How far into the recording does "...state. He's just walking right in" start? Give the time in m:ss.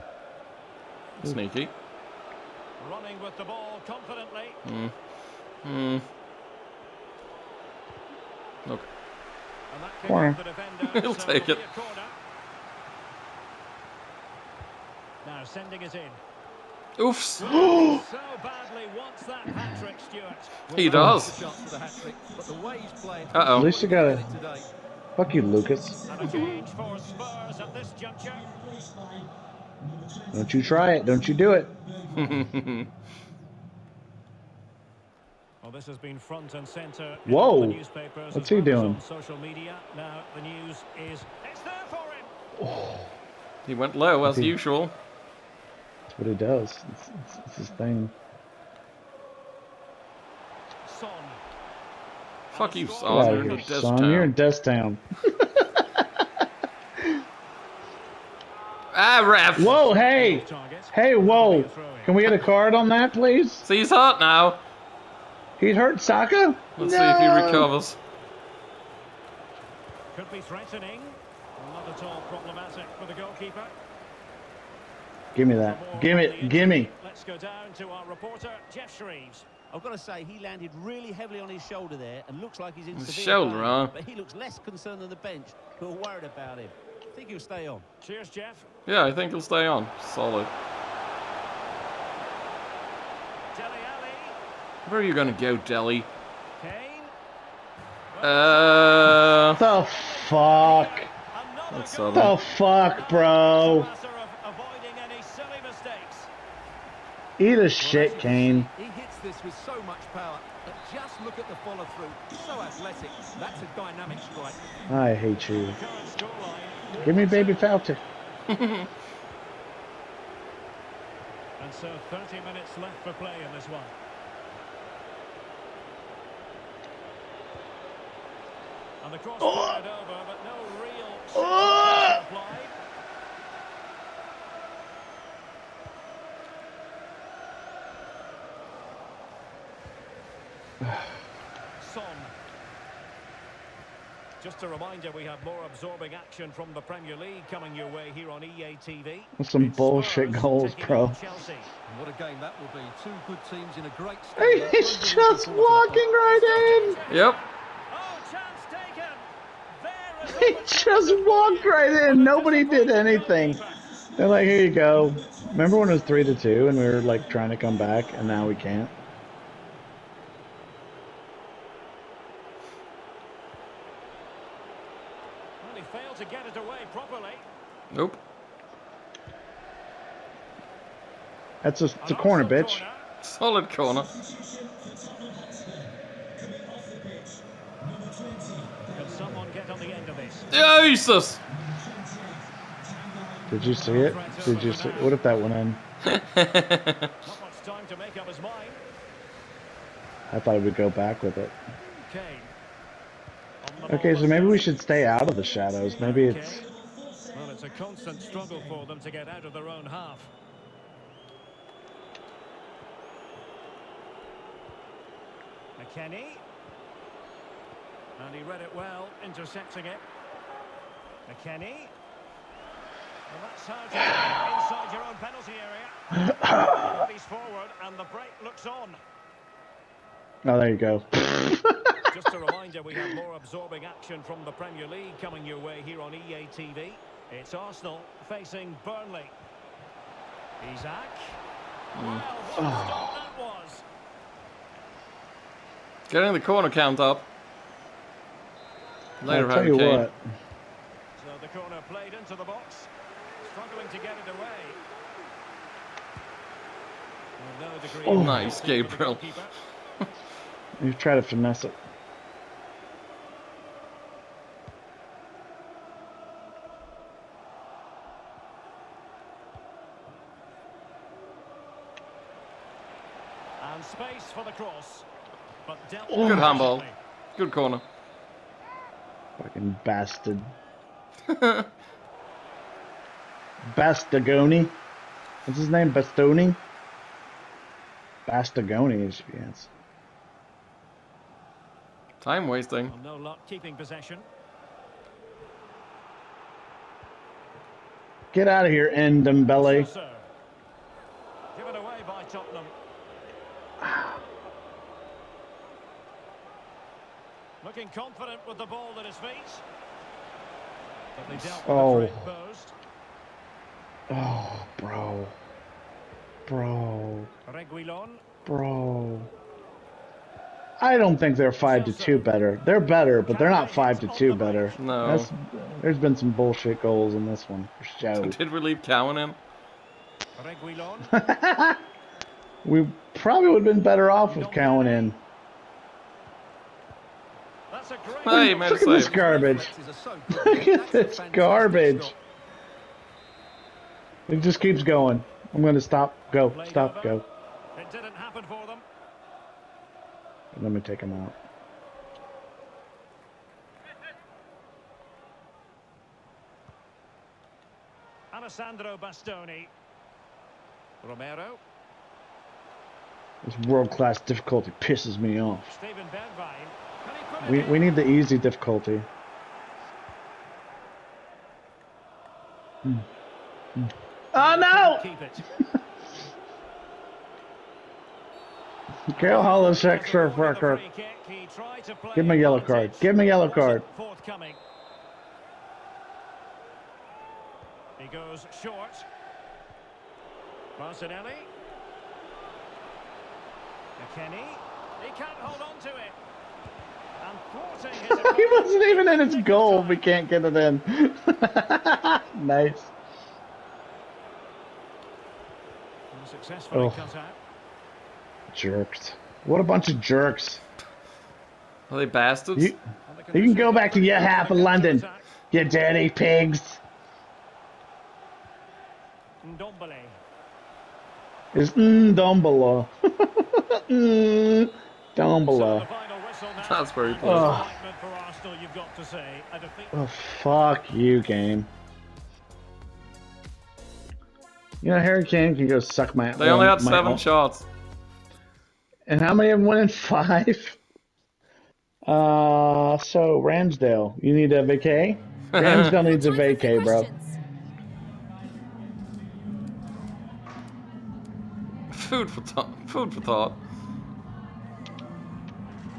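2:34.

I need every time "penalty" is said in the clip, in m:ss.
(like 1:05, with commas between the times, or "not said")
3:45.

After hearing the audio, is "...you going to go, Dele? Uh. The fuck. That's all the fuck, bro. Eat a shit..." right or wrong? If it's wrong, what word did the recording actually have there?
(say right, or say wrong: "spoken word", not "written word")
right.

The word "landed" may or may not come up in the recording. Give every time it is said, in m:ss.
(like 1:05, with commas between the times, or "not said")
1:20.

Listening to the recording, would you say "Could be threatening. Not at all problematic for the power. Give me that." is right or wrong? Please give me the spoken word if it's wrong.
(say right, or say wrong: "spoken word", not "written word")
wrong: "goalkeeper", not "power".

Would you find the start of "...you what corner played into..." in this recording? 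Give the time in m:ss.
4:09.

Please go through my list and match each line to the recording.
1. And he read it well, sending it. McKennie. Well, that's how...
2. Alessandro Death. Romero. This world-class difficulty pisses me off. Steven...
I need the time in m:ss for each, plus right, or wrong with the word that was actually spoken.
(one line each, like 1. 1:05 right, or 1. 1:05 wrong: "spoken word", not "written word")
1. 3:38 wrong: "intercepting", not "sending"
2. 5:58 wrong: "Bastoni", not "Death".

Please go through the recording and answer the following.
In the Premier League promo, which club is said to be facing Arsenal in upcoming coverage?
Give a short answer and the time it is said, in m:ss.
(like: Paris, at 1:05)
Burnley, at 3:58.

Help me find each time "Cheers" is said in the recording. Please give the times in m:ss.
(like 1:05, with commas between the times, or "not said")
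1:28.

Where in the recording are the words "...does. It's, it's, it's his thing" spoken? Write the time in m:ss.
0:46.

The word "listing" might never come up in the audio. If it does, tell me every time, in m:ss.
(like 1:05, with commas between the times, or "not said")
not said.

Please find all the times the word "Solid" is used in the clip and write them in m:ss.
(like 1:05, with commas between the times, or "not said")
1:30, 3:03.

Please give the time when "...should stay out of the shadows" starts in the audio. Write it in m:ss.
3:24.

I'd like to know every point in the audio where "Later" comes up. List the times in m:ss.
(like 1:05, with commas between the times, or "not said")
4:09.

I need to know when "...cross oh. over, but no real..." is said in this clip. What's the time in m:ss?
2:09.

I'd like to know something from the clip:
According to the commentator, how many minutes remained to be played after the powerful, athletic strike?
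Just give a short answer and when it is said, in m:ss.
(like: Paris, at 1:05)
30, at 2:02.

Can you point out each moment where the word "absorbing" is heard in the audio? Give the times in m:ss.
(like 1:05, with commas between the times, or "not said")
2:25, 3:53.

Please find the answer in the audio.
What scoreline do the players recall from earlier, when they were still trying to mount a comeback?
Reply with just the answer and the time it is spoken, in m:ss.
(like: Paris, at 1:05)
3-2, at 2:46.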